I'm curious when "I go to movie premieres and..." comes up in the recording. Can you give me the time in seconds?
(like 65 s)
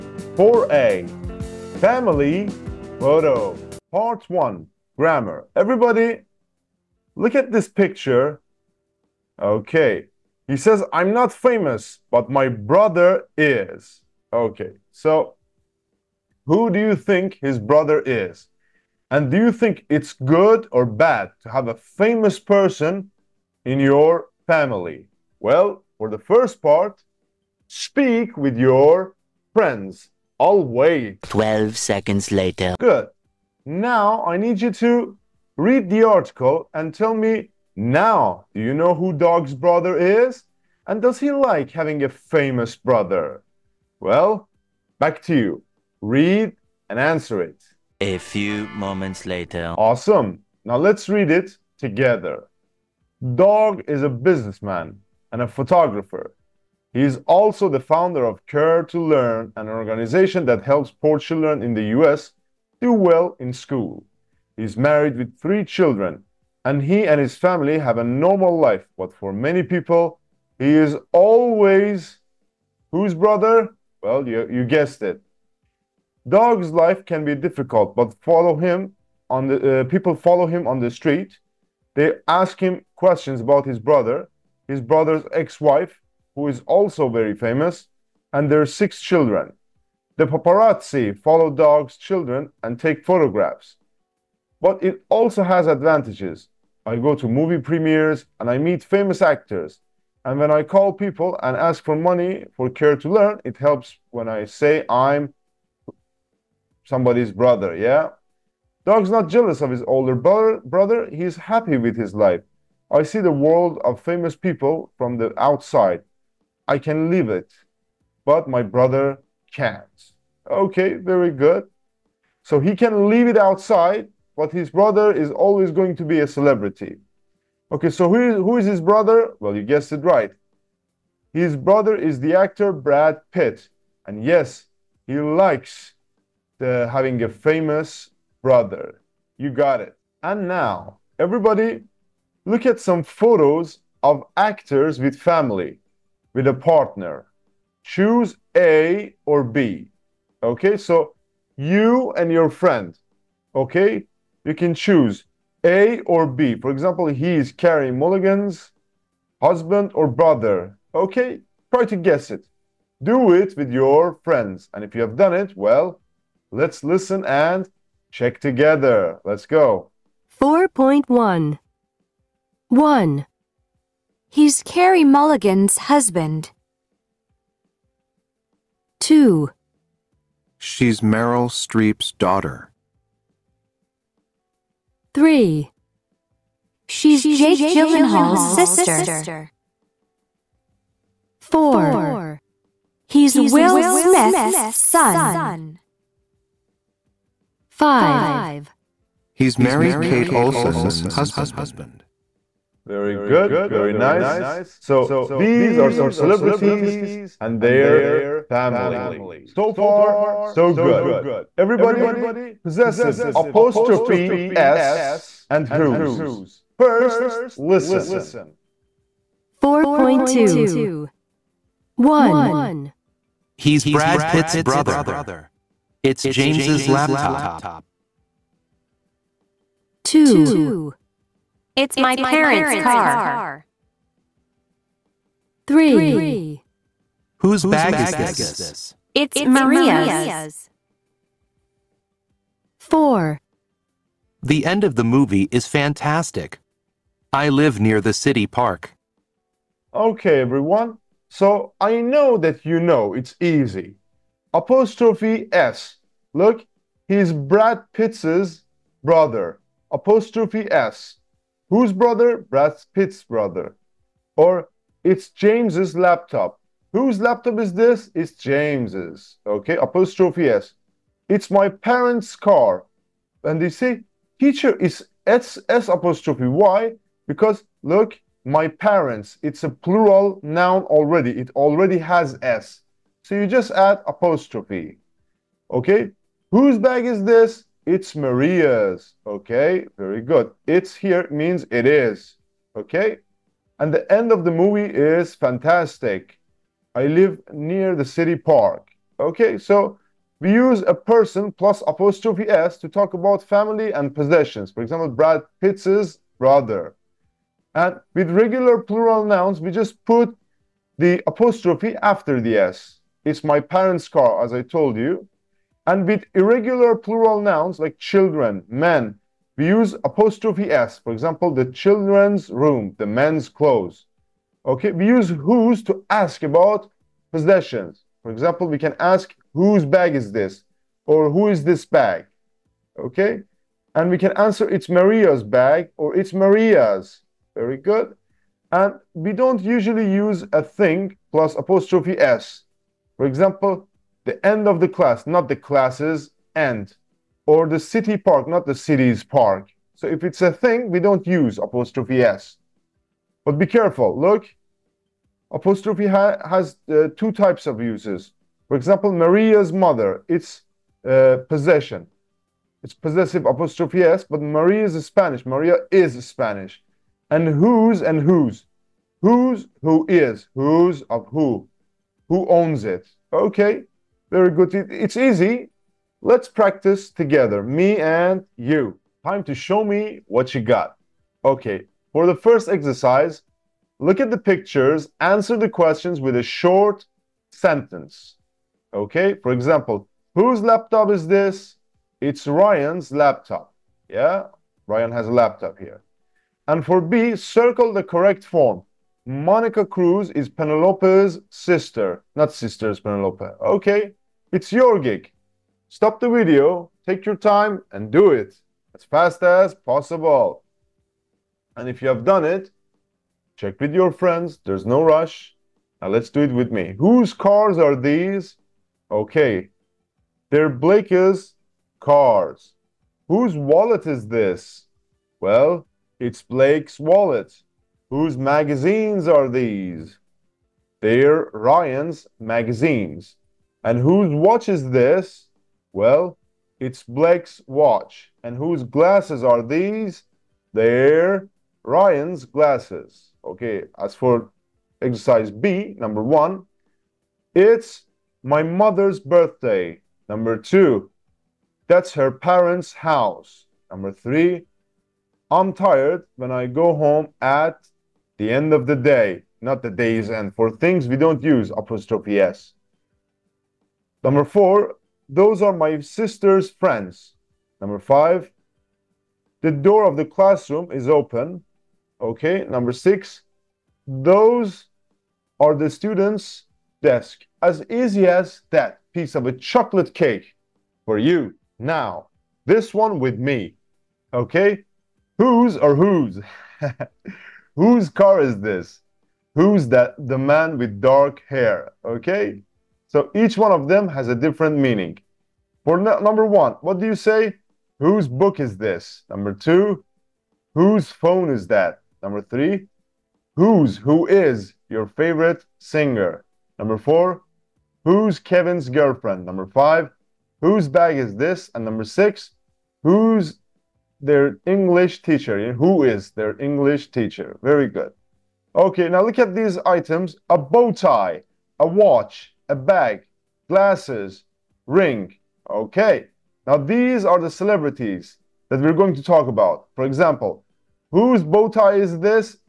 96 s.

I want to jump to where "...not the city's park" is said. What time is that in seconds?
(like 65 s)
348 s.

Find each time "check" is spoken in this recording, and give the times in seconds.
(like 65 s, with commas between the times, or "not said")
168 s, 413 s.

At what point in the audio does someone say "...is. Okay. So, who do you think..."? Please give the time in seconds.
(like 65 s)
13 s.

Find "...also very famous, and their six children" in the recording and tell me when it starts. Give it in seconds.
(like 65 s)
86 s.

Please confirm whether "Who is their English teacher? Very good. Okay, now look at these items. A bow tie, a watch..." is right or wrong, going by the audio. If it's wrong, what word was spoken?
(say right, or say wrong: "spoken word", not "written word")
right.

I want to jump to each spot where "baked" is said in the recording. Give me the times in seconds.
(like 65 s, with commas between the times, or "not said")
not said.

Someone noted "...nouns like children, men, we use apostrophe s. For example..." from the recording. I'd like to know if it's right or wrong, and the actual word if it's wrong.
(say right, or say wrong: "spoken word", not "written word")
right.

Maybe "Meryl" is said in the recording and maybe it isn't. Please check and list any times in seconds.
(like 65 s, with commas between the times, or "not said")
181 s.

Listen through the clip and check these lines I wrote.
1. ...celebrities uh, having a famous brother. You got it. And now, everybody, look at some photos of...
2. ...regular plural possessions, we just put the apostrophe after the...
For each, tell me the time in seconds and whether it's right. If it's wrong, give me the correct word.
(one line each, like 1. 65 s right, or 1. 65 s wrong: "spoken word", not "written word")
1. 135 s wrong: "likes", not "celebrities"
2. 308 s wrong: "nouns", not "possessions".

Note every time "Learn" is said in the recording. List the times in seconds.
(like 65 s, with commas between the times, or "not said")
59 s, 103 s.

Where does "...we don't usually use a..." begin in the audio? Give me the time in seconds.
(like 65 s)
339 s.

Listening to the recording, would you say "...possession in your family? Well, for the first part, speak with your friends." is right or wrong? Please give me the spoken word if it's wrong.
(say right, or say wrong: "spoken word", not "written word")
wrong: "person", not "possession".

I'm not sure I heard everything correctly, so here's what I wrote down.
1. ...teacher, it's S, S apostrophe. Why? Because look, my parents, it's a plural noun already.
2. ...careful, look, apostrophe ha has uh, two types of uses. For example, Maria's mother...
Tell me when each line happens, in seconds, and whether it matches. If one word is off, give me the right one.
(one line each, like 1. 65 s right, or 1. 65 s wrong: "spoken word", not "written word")
1. 274 s right
2. 353 s right.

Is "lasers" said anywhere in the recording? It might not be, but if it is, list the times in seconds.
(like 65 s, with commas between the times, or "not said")
not said.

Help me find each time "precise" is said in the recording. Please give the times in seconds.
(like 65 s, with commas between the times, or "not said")
not said.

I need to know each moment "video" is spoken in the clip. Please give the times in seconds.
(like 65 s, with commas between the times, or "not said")
406 s.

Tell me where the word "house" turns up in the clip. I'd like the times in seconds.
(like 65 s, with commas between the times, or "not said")
452 s.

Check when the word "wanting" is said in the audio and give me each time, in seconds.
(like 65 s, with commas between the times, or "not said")
not said.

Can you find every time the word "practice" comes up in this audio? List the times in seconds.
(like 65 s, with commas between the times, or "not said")
376 s.